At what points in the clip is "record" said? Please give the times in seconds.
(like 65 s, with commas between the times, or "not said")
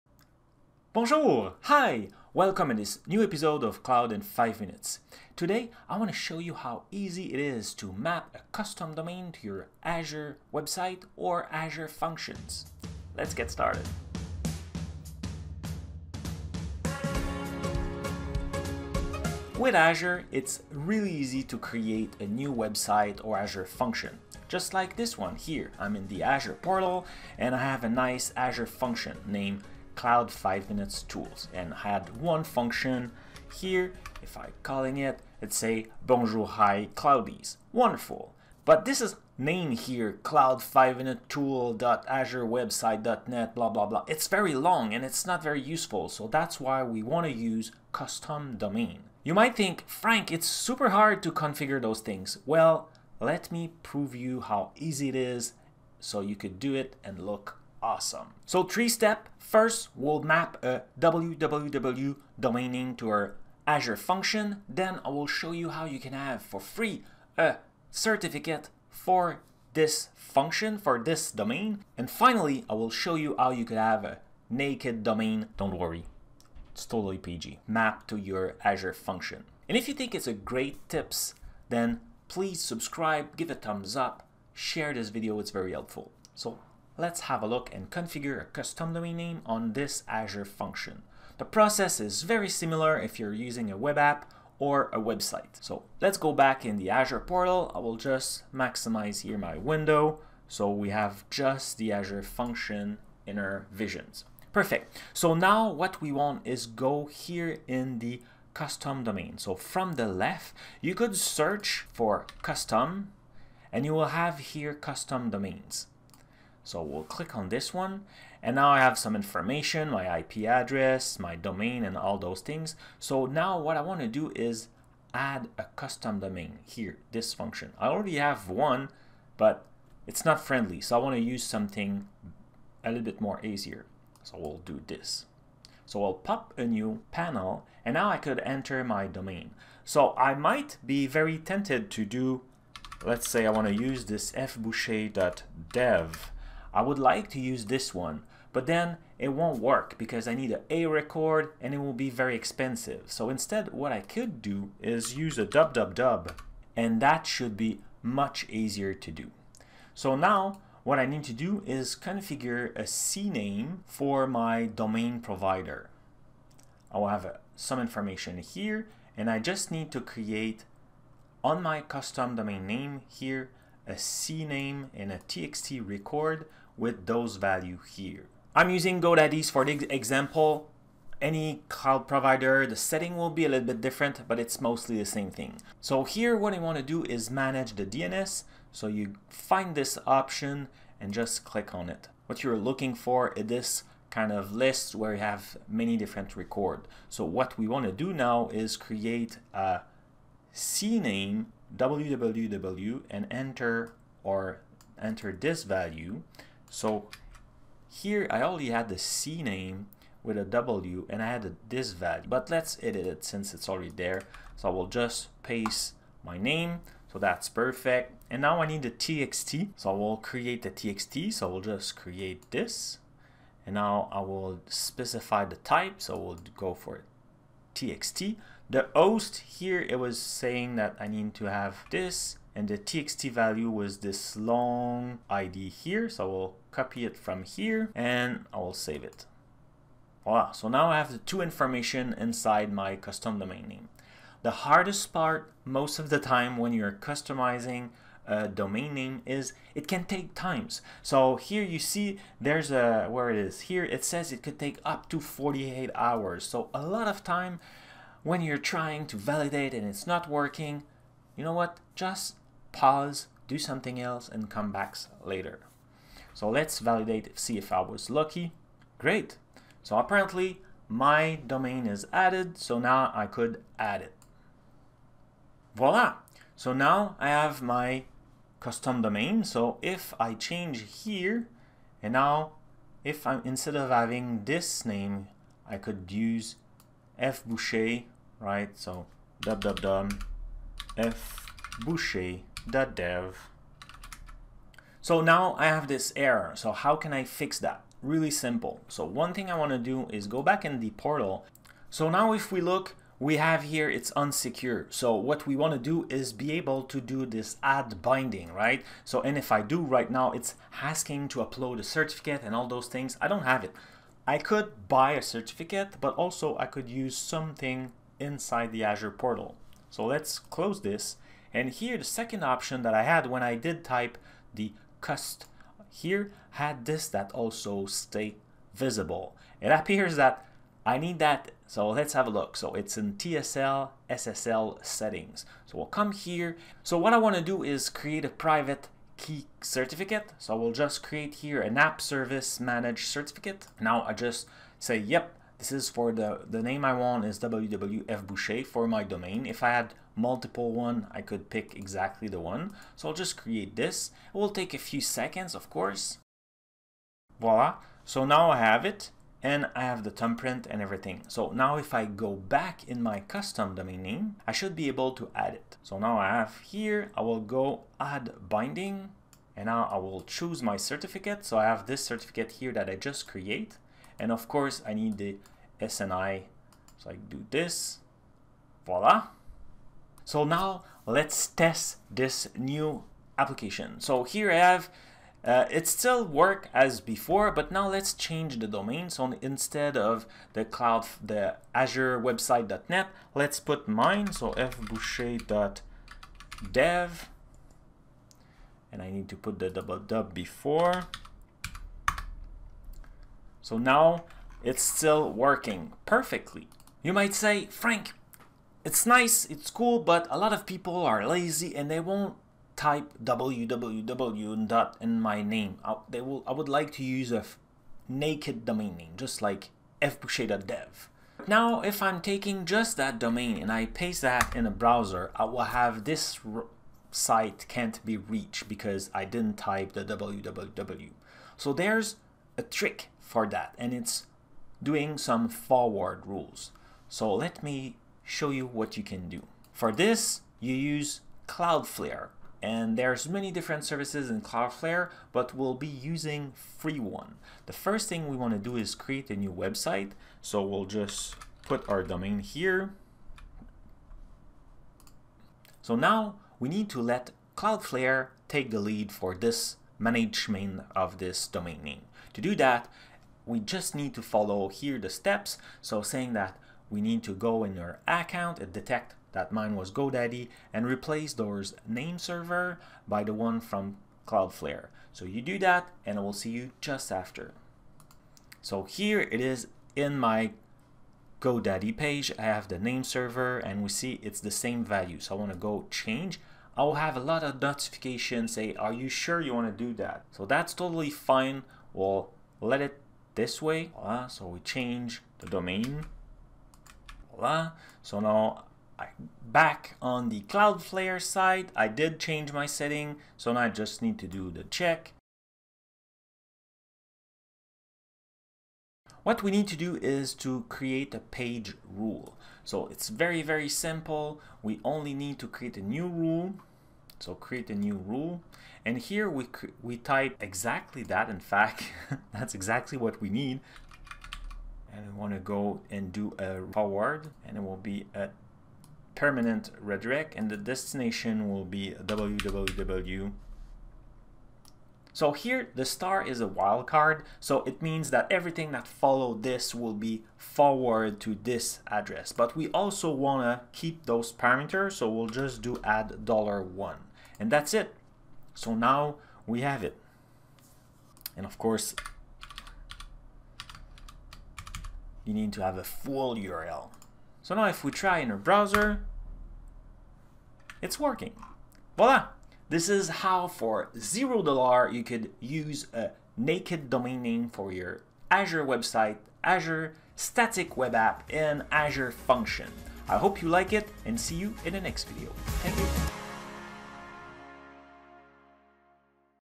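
150 s, 175 s, 196 s.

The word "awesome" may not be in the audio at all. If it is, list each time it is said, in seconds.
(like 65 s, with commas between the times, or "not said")
57 s.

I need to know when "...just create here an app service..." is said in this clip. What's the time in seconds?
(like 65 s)
340 s.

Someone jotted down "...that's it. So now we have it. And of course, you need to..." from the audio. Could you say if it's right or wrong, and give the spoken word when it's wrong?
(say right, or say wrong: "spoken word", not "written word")
right.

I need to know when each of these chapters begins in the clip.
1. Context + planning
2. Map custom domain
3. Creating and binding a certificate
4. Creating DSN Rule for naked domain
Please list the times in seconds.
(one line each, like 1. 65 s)
1. 18 s
2. 96 s
3. 297 s
4. 407 s.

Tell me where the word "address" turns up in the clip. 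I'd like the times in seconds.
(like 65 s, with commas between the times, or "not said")
120 s, 541 s.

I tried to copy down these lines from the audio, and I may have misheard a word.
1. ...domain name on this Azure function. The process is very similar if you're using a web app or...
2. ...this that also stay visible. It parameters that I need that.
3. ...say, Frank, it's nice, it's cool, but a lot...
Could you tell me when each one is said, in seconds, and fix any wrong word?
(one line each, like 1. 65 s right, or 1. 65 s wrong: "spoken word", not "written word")
1. 88 s right
2. 326 s wrong: "appears", not "parameters"
3. 407 s right.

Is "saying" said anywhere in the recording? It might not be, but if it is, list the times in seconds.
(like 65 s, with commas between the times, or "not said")
230 s, 466 s.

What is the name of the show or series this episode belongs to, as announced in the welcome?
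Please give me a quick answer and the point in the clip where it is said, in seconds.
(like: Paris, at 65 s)
Cloud in 5 Minutes, at 3 s.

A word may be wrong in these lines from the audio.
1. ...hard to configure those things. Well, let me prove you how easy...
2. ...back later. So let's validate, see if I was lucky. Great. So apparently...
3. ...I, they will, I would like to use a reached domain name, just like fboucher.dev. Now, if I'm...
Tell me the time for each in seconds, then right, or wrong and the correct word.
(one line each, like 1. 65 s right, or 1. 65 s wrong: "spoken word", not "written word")
1. 50 s right
2. 264 s right
3. 415 s wrong: "naked", not "reached".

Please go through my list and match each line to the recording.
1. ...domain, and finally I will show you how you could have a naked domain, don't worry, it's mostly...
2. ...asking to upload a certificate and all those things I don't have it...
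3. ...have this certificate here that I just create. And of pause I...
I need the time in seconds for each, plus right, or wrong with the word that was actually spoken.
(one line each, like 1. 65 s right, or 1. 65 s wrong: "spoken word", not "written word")
1. 71 s wrong: "totally", not "mostly"
2. 310 s right
3. 371 s wrong: "course", not "pause".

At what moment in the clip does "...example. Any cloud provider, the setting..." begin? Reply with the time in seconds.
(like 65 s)
179 s.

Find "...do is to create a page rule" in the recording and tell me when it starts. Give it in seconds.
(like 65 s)
509 s.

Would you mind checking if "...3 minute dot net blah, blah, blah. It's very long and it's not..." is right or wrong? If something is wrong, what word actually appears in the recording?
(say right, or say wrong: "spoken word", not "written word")
wrong: "5", not "3".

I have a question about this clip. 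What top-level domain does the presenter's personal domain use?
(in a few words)
dev.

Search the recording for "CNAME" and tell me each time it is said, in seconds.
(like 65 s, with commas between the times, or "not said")
162 s, 173 s, 200 s.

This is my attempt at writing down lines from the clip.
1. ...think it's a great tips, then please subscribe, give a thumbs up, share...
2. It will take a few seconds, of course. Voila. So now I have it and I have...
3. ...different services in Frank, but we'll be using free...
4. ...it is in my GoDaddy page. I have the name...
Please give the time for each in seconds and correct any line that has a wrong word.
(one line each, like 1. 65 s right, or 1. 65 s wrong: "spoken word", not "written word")
1. 79 s right
2. 354 s right
3. 443 s wrong: "Cloudflare", not "Frank"
4. 479 s right.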